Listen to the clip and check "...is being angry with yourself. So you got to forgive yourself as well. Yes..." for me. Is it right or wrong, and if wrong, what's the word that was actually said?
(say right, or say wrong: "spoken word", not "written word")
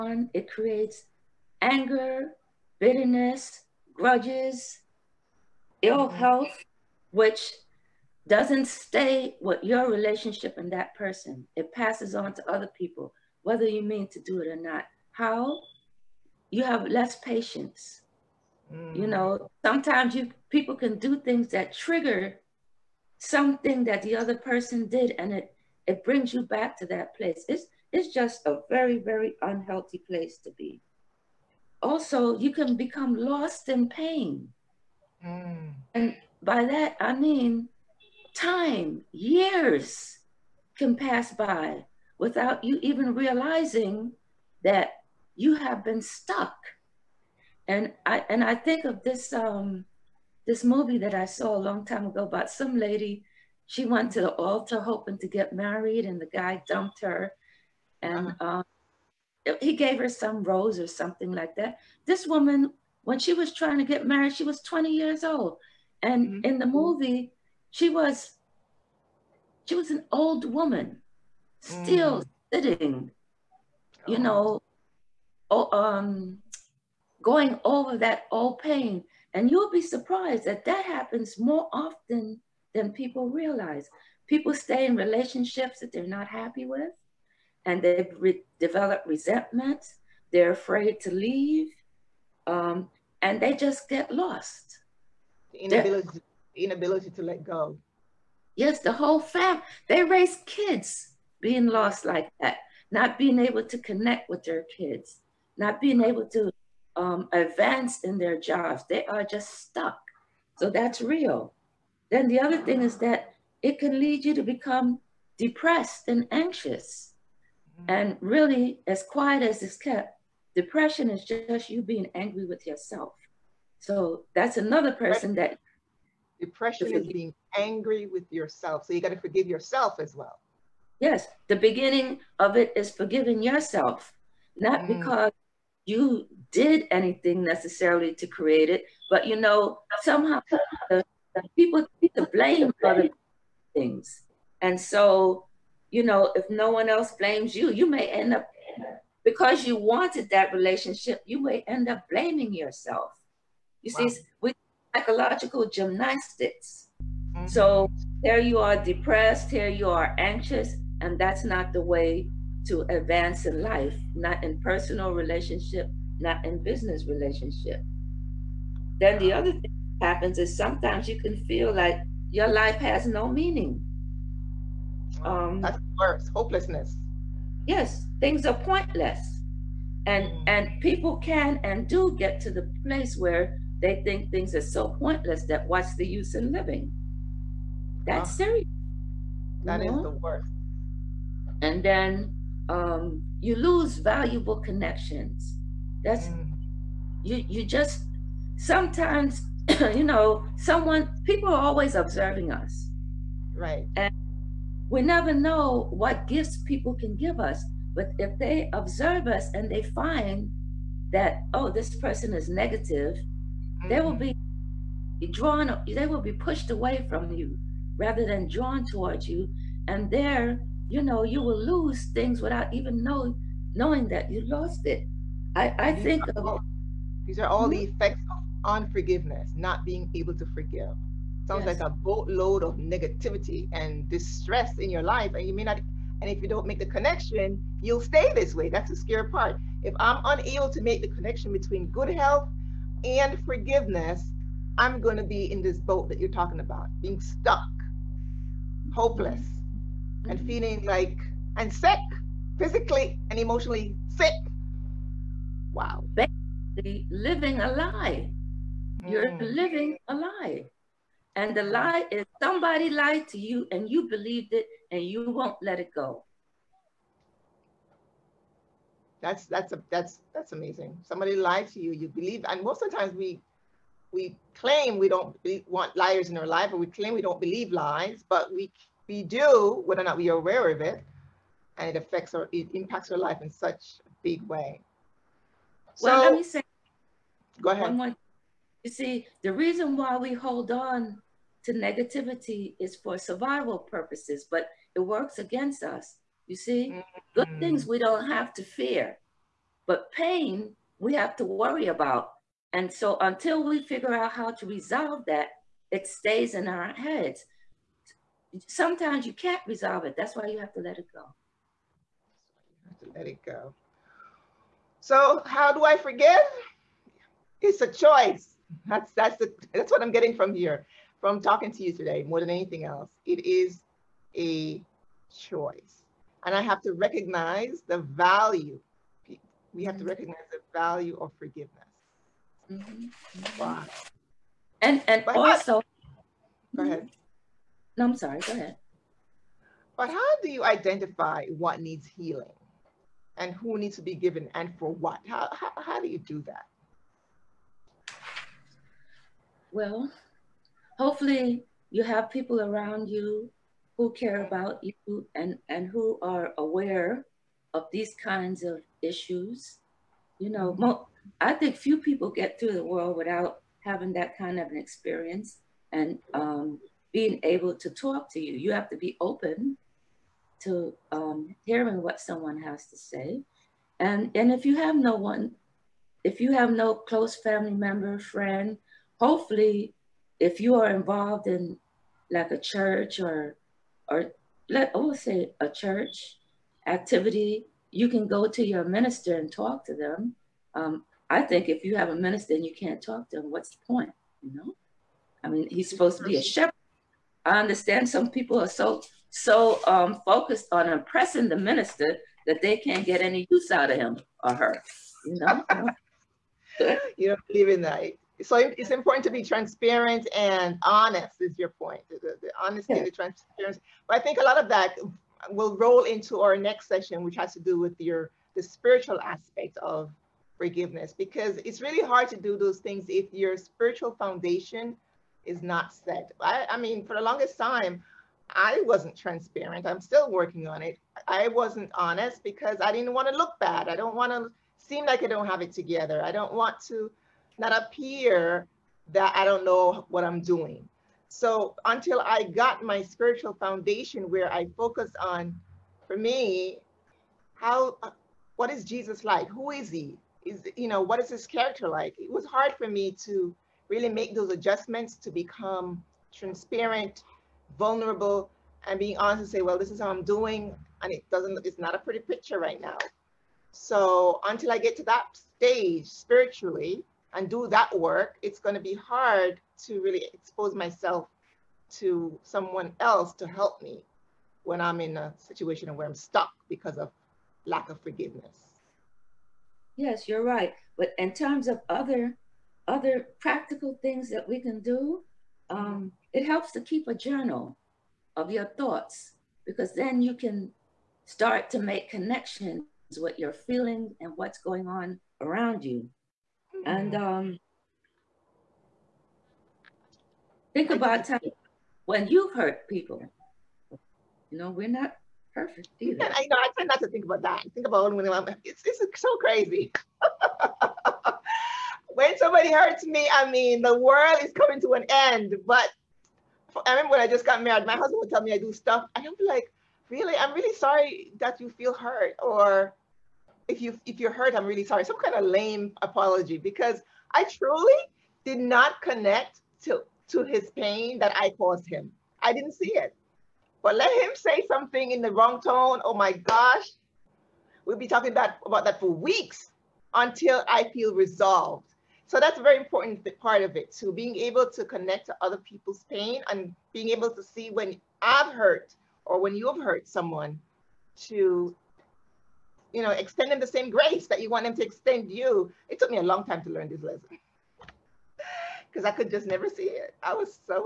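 right.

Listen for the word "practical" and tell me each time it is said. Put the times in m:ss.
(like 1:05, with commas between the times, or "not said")
8:03.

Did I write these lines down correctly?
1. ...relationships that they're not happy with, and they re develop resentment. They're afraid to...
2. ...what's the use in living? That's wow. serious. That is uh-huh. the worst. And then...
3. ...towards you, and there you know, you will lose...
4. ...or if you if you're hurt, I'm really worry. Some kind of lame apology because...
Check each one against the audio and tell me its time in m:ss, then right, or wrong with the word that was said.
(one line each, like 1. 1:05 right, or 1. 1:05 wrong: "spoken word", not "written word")
1. 1:24 right
2. 3:05 right
3. 3:38 right
4. 8:42 wrong: "sorry", not "worry".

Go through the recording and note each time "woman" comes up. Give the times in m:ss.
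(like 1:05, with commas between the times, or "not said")
1:02, 1:10.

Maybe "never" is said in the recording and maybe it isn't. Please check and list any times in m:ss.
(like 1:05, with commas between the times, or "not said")
3:25, 9:19.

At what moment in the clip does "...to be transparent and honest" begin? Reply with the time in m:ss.
6:49.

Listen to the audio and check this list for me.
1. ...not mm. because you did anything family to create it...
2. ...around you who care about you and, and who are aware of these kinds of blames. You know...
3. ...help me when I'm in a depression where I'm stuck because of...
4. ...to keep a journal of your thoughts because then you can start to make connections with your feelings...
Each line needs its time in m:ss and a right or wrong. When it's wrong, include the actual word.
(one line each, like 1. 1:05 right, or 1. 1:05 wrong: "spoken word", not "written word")
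1. 2:14 wrong: "necessarily", not "family"
2. 5:52 wrong: "issues", not "blames"
3. 7:53 wrong: "situation", not "depression"
4. 8:06 right.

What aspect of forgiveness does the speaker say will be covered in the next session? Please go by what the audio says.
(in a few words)
the spiritual aspect.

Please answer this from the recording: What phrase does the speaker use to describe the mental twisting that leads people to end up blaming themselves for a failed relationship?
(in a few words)
psychological gymnastics.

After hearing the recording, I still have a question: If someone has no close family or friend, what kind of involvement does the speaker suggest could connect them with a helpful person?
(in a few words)
church activity.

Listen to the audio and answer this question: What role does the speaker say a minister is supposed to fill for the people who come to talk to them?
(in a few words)
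a shepherd.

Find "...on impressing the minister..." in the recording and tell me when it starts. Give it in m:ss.
6:40.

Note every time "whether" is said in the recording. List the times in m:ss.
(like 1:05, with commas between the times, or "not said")
0:13, 4:39.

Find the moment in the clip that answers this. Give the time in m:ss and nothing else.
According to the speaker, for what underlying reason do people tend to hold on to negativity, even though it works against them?
4:53.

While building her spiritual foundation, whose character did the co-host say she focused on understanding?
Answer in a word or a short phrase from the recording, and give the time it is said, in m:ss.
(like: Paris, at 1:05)
Jesus, at 7:28.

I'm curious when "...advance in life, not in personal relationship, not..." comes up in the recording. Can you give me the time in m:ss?
2:42.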